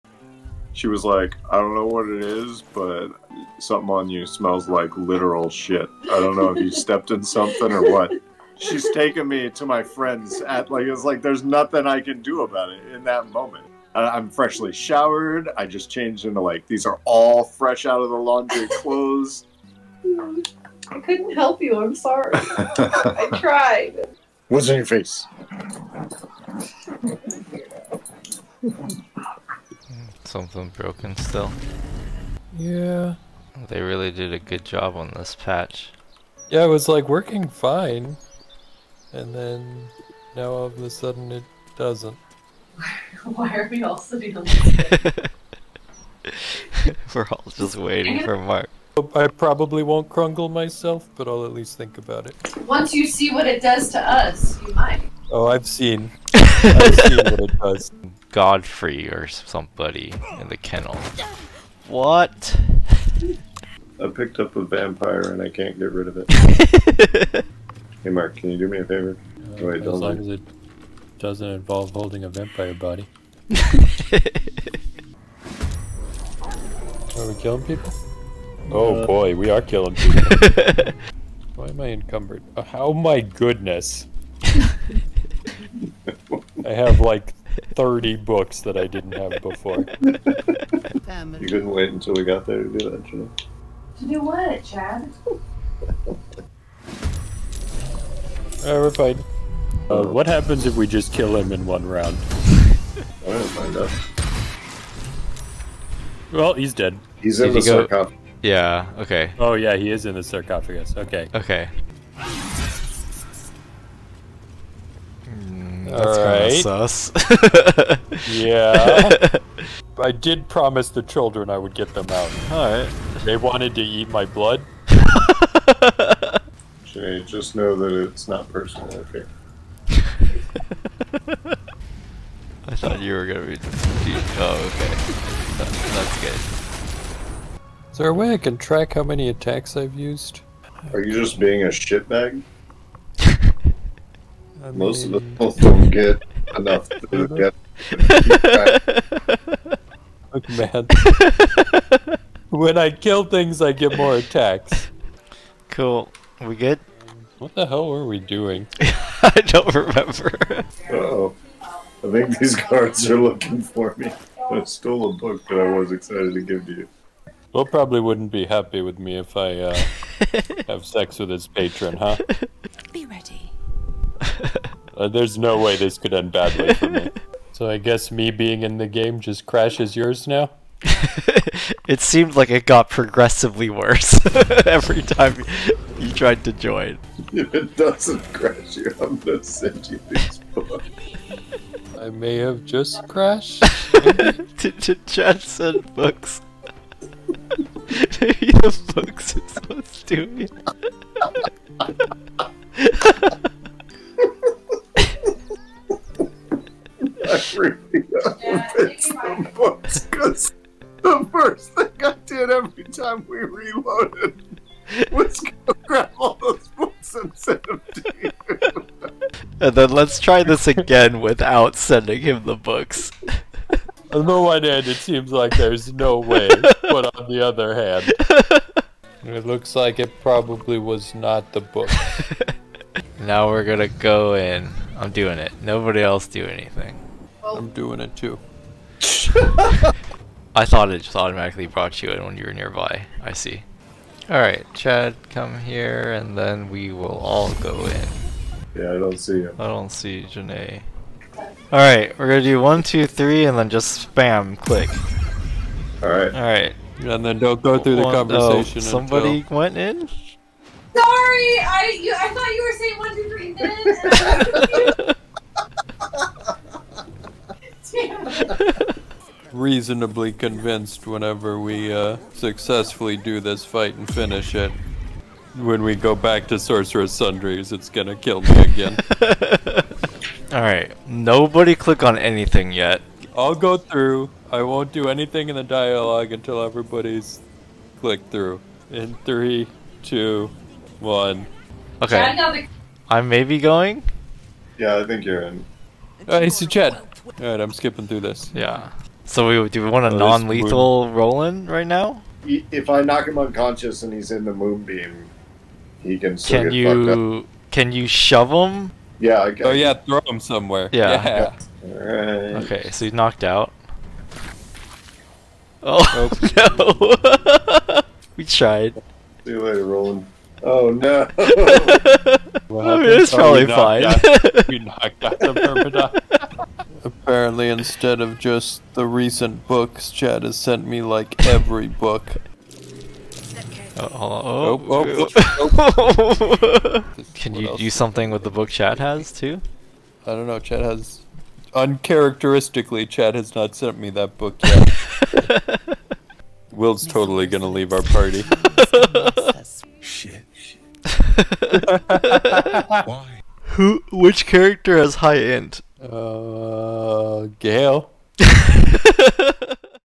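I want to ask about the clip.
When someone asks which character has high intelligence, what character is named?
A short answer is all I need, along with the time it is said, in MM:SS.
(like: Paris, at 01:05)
Gale, at 05:57.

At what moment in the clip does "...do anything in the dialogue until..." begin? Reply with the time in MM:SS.
04:44.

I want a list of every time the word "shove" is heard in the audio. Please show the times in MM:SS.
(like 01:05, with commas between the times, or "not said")
05:08.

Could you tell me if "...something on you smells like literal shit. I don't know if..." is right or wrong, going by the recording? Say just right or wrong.
right.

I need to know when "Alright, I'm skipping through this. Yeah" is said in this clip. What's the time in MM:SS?
04:57.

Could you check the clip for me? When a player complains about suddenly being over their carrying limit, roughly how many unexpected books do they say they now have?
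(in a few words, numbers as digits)
30.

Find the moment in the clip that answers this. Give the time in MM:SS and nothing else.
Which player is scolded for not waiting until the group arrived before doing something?
01:33.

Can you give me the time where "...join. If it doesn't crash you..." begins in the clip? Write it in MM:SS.
03:06.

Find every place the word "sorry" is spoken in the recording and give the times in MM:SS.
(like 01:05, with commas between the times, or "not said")
00:21, 04:20.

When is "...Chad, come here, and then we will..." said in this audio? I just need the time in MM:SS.
04:04.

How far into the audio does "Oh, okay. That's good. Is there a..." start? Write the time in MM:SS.
02:13.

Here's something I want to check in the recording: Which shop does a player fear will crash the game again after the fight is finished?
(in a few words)
Sorcerer's Sundries.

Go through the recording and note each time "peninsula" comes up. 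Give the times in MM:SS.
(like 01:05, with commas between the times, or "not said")
not said.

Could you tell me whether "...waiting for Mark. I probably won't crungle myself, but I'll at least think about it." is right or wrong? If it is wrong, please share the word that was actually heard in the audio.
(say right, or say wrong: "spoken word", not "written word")
right.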